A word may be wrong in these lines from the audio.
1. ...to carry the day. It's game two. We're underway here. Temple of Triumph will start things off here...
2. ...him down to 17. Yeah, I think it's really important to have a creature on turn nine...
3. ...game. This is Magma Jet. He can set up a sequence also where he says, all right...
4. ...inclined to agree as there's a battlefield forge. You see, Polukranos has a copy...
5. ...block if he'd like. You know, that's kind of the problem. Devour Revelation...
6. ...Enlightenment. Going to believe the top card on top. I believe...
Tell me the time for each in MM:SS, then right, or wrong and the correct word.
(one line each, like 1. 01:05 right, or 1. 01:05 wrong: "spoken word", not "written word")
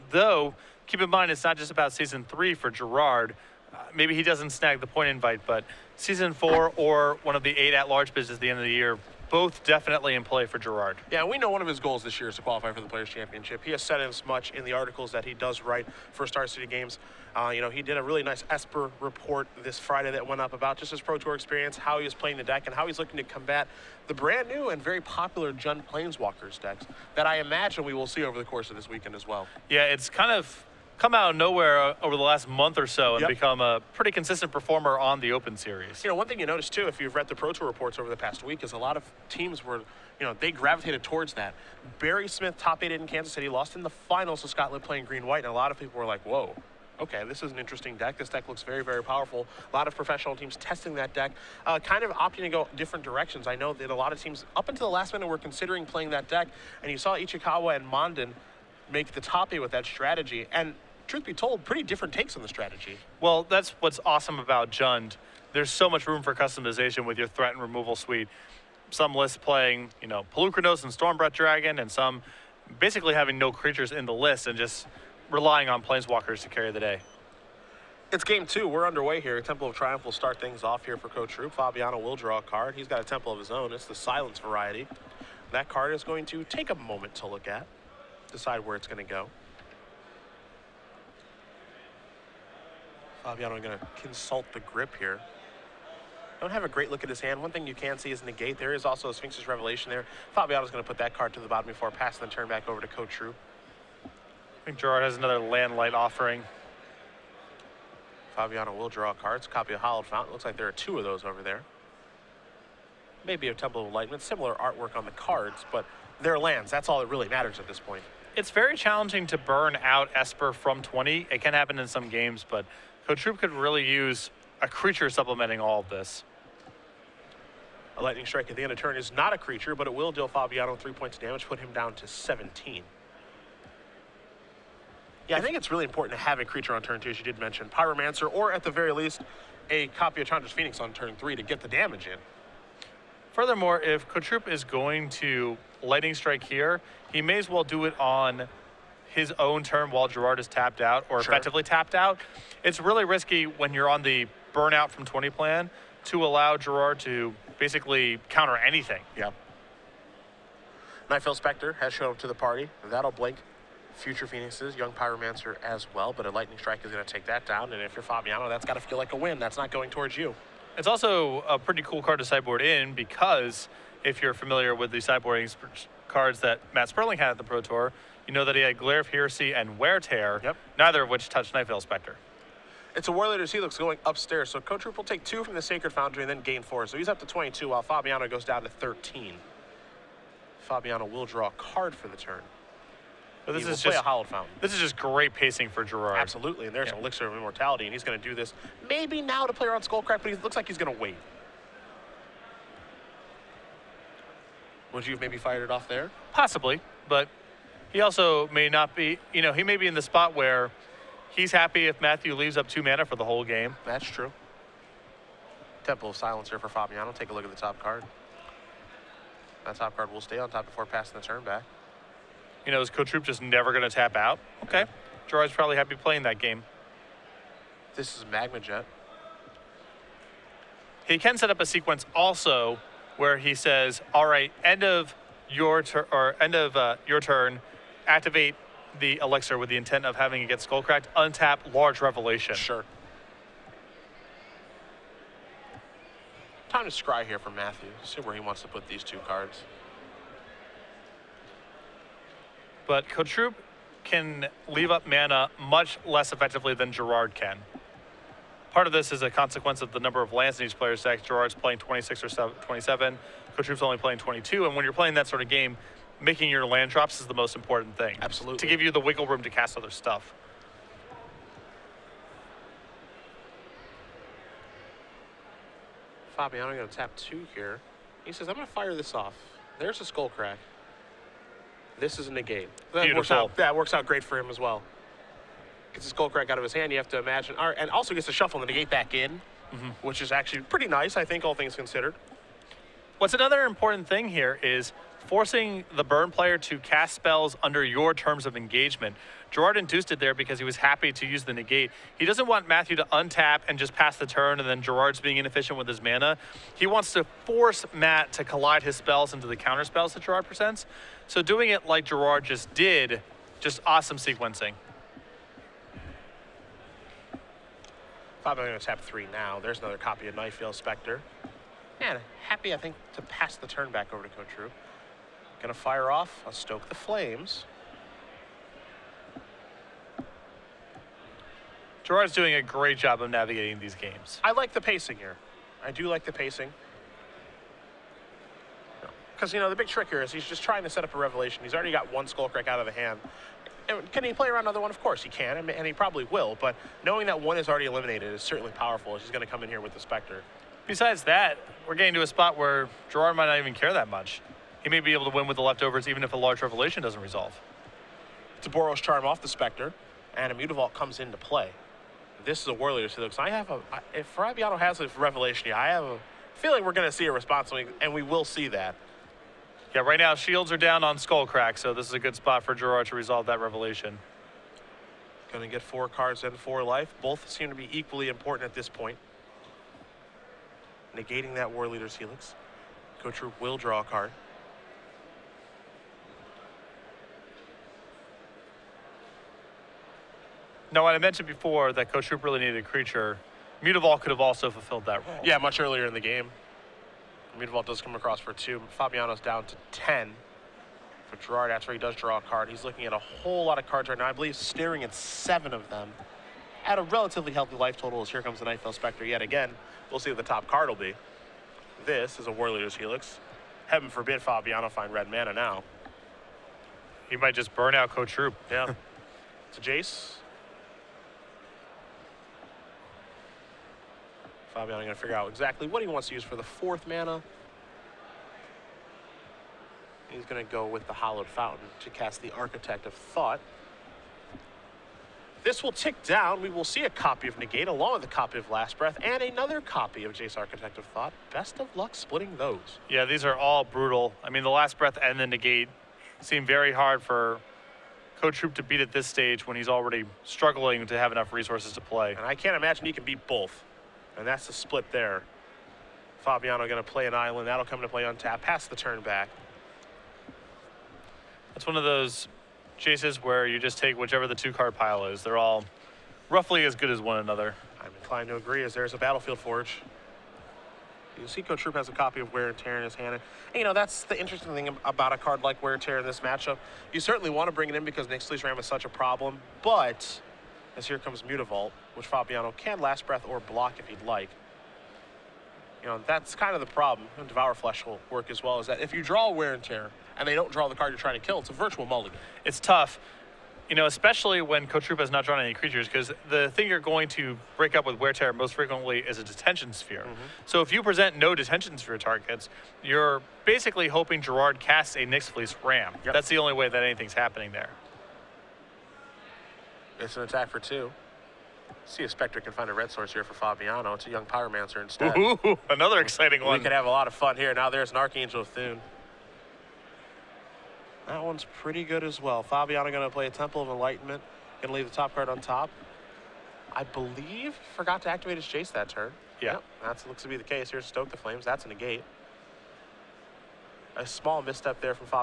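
1. 01:16 right
2. 02:11 wrong: "two", not "nine"
3. 03:46 right
4. 07:48 wrong: "Cotrupe", not "Polukranos"
5. 08:03 wrong: "Flesh", not "Revelation"
6. 08:43 wrong: "leave", not "believe".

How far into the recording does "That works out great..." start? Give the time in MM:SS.
04:43.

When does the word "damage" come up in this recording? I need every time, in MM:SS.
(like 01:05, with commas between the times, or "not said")
02:11, 02:21.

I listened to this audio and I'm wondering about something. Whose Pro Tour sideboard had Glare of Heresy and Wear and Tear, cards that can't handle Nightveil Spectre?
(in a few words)
Matt Sperling.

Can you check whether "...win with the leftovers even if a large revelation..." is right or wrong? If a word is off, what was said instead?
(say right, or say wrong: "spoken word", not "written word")
right.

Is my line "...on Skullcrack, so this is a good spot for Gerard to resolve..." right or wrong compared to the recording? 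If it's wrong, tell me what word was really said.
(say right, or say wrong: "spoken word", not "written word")
right.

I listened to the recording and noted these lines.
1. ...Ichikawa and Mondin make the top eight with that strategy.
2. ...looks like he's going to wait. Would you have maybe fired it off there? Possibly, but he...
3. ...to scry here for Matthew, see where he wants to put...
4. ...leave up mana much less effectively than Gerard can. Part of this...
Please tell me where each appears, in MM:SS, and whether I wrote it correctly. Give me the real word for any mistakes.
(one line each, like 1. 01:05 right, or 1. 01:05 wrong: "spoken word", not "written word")
1. 00:57 right
2. 03:20 right
3. 04:06 right
4. 04:14 right.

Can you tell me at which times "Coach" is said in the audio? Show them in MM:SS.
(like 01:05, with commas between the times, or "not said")
05:24, 06:23.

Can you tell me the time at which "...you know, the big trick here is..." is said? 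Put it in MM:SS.
05:39.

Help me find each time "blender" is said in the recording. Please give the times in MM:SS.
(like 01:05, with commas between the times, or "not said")
not said.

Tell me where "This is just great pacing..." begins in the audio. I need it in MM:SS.
03:14.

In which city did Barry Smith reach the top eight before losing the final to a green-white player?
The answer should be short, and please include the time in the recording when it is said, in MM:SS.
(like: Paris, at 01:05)
Kansas City, at 00:43.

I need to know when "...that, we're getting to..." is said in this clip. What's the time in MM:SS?
05:51.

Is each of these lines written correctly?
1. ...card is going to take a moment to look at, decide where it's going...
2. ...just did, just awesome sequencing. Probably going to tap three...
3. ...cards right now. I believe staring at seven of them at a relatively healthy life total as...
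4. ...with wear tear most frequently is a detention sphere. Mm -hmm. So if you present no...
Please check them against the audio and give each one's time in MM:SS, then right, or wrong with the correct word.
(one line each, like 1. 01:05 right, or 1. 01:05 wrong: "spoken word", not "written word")
1. 01:25 right
2. 05:12 right
3. 06:43 right
4. 08:18 right.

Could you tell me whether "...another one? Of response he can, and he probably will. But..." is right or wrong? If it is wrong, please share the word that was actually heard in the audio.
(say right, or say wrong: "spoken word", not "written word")
wrong: "course", not "response".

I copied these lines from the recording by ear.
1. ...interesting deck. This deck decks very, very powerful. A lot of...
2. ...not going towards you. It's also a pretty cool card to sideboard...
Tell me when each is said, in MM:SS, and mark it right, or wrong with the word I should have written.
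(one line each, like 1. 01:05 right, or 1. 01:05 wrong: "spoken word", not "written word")
1. 00:47 wrong: "looks", not "decks"
2. 02:49 right.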